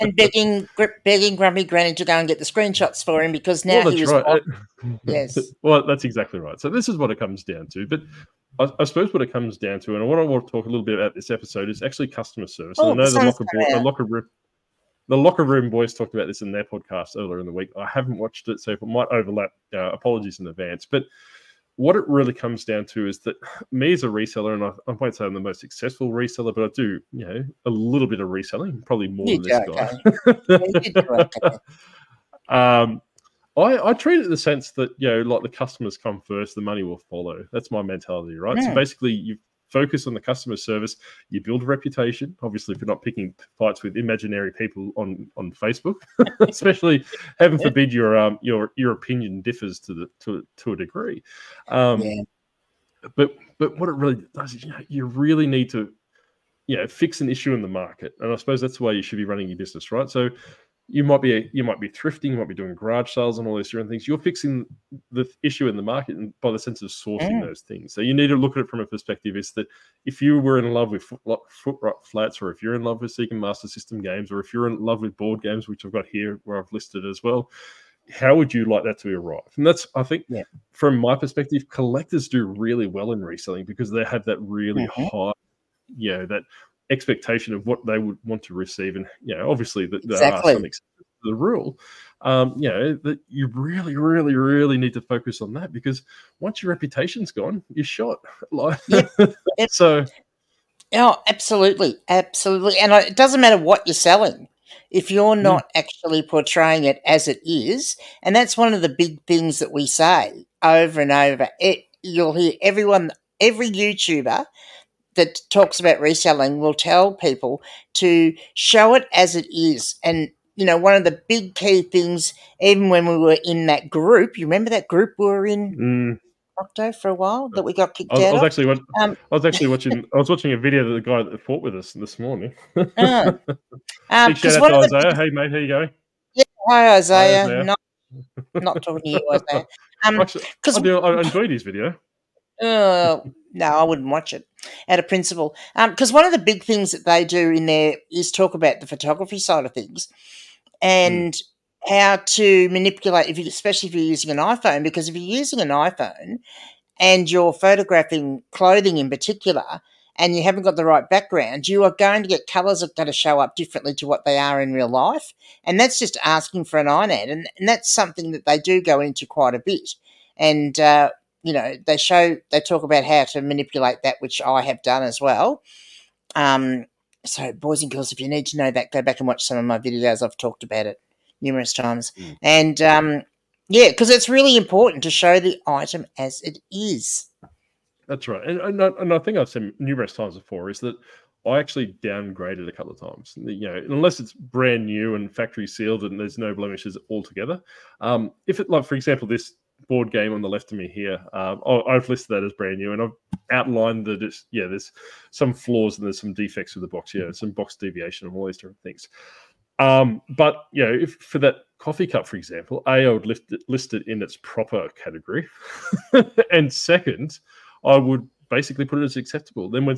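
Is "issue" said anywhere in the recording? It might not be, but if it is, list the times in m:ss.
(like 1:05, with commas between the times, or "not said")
0:57, 1:05.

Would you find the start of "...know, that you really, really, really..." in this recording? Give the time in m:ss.
1:32.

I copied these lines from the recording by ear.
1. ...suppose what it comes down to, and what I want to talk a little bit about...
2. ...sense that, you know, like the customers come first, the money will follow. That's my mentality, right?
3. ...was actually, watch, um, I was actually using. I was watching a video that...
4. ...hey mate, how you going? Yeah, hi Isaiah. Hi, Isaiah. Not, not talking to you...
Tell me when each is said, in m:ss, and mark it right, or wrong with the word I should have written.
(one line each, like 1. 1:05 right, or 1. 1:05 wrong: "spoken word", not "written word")
1. 0:08 right
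2. 0:34 right
3. 2:08 wrong: "watching", not "using"
4. 2:15 right.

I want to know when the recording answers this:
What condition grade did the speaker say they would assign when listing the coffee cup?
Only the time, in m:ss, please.
3:39.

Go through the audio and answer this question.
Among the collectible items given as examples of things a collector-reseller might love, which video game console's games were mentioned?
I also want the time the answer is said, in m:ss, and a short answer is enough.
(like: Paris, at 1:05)
Sega Master System, at 1:13.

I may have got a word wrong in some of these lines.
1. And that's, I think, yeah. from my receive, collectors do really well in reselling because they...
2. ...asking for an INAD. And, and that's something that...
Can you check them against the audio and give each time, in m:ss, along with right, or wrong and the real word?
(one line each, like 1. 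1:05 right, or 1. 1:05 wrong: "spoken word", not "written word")
1. 1:19 wrong: "perspective", not "receive"
2. 2:46 right.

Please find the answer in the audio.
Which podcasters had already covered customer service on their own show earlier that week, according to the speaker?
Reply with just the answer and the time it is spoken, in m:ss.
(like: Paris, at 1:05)
The locker room boys, at 0:15.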